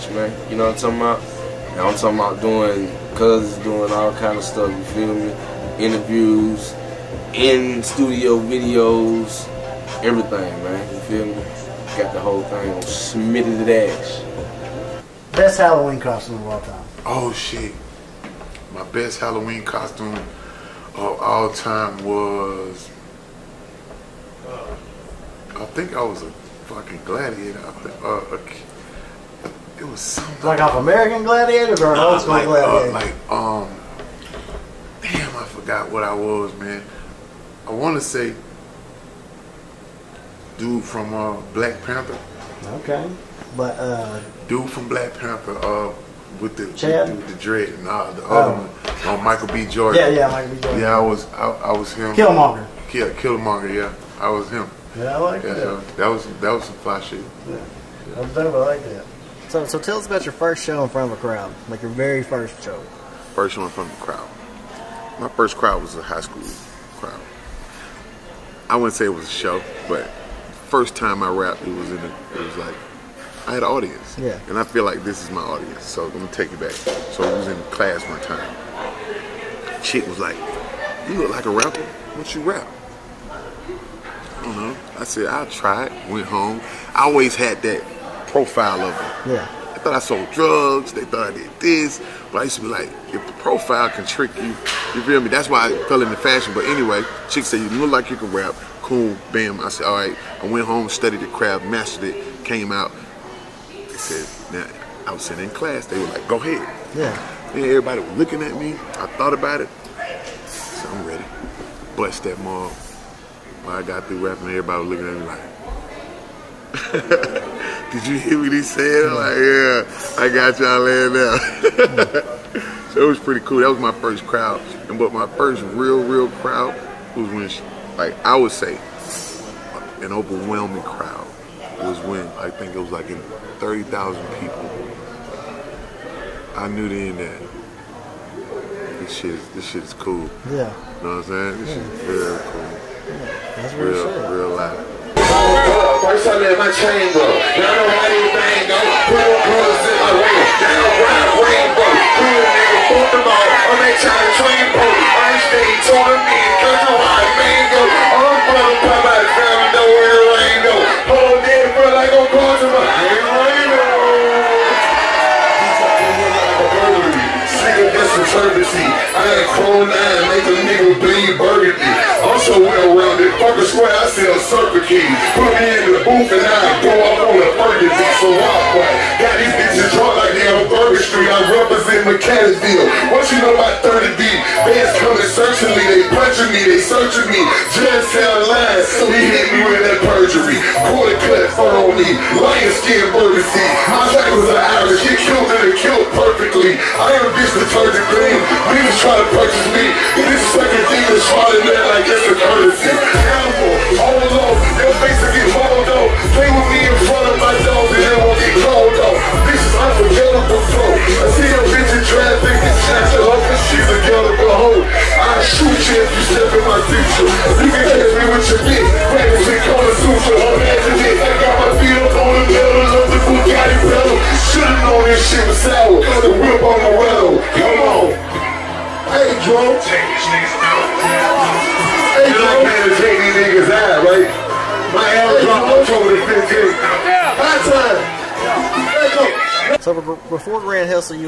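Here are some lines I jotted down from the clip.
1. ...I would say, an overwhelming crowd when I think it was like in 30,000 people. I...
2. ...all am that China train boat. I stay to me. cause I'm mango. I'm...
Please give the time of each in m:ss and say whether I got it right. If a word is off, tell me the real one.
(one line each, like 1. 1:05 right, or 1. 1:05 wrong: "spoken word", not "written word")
1. 2:08 right
2. 2:33 right.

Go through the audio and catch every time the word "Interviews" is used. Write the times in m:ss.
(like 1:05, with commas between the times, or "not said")
0:05.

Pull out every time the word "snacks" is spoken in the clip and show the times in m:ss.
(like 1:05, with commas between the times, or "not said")
not said.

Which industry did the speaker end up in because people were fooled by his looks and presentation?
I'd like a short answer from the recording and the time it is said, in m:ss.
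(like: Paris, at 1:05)
fashion, at 1:36.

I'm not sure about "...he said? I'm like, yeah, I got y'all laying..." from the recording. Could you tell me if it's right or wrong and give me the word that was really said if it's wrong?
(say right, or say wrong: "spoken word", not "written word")
right.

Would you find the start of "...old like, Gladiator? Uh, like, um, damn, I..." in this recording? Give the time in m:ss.
0:31.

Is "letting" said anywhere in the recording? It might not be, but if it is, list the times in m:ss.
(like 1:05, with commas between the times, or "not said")
not said.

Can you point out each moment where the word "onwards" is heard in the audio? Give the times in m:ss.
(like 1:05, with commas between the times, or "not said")
not said.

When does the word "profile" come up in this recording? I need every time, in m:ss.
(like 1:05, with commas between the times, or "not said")
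1:28, 1:33.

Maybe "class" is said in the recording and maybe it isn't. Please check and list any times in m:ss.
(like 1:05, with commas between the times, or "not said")
1:17, 1:45.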